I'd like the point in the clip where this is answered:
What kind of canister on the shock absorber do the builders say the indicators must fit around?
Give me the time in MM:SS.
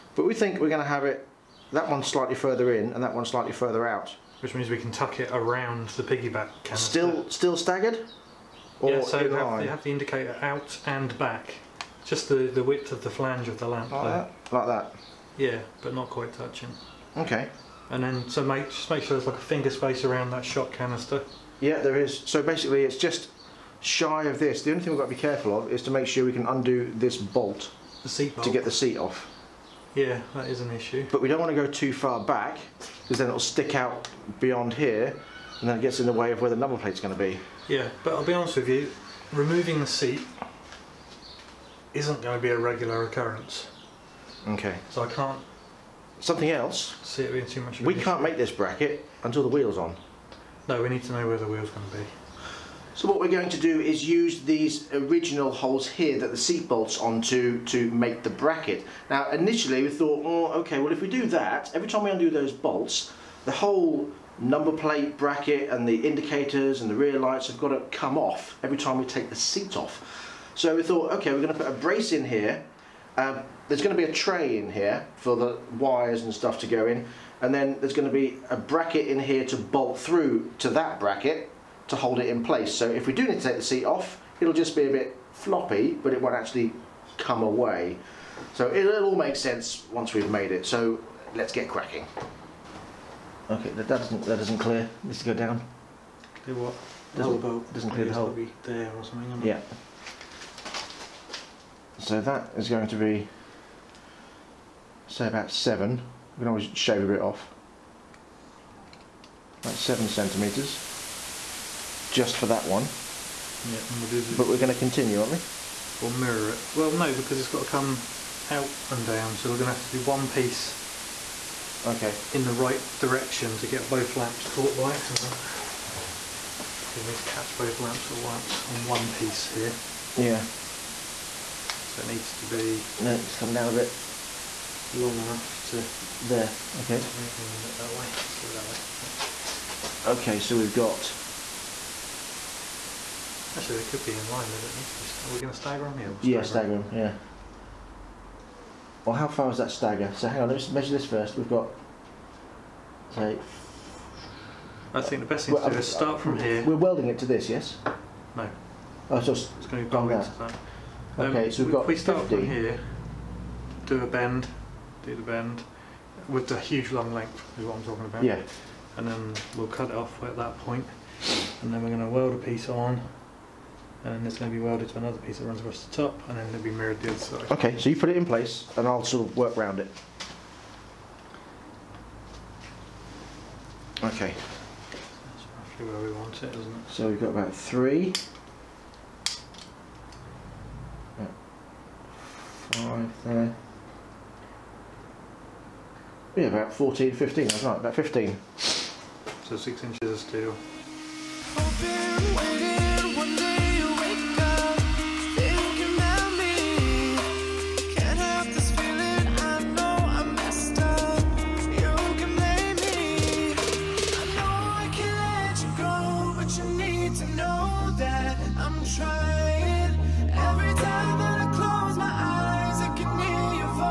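00:06.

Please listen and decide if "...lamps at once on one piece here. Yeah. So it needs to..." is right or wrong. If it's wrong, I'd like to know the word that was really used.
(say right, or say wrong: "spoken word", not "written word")
right.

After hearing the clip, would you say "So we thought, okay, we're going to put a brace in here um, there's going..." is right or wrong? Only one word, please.
right.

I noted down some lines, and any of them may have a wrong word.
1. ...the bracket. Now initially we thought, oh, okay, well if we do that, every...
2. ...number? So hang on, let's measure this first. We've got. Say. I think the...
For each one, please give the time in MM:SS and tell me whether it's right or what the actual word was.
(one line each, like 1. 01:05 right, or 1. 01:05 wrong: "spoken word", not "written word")
1. 00:58 right
2. 02:29 wrong: "stagger", not "number".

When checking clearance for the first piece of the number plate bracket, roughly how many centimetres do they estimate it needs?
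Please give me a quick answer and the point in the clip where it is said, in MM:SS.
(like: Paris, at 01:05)
7 centimetres, at 01:49.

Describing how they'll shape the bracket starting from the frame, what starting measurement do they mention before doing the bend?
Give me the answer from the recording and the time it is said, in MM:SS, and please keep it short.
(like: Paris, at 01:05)
50, at 02:42.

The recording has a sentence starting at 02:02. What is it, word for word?
in the right direction to get both lamps caught by.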